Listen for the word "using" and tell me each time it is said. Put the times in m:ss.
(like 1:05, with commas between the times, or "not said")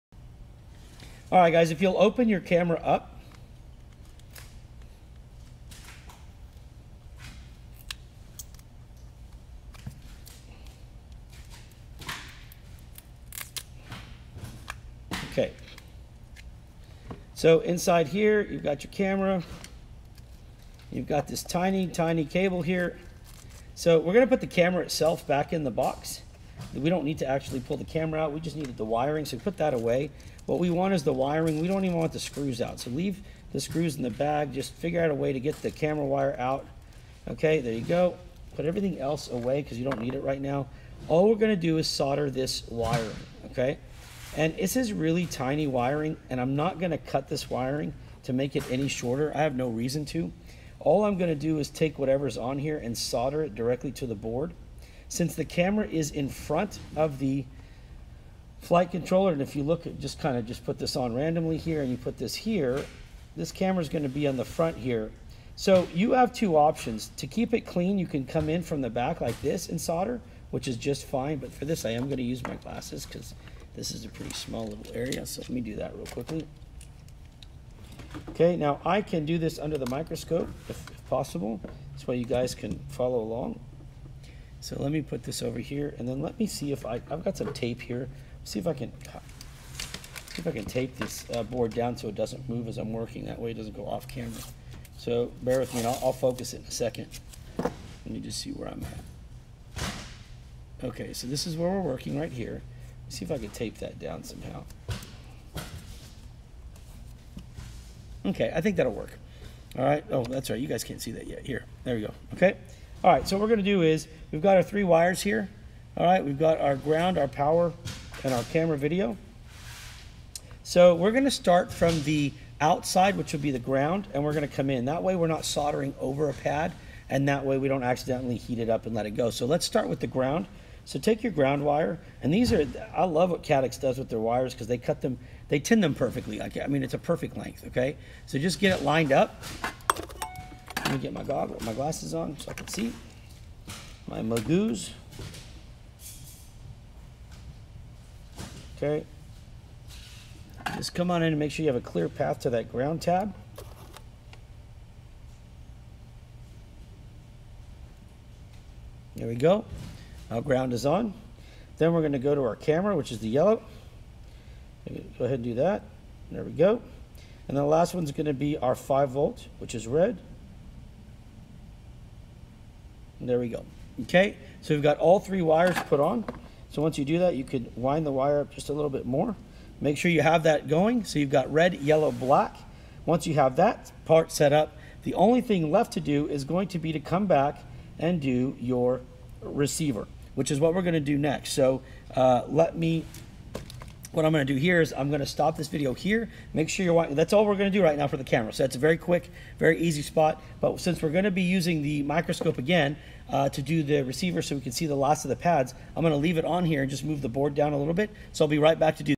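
3:21.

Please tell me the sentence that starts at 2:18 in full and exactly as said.
So just get it lined up, let me get my goggle, my glasses on so I can see.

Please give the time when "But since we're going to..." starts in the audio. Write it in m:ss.
3:20.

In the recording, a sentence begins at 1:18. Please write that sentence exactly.
Okay, now I can do this under the microscope if, if possible.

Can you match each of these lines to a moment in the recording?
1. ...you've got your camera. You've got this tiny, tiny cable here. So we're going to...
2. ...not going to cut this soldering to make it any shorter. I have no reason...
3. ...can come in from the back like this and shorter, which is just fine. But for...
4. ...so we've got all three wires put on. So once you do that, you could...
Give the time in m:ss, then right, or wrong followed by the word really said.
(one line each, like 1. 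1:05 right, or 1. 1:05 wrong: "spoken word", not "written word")
1. 0:18 right
2. 0:46 wrong: "wiring", not "soldering"
3. 1:08 wrong: "solder", not "shorter"
4. 2:54 right.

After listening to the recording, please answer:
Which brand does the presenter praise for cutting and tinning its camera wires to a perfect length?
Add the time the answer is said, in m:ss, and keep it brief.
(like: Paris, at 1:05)
Caddx, at 2:13.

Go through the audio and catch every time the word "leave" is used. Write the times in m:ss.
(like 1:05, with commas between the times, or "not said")
0:32, 3:26.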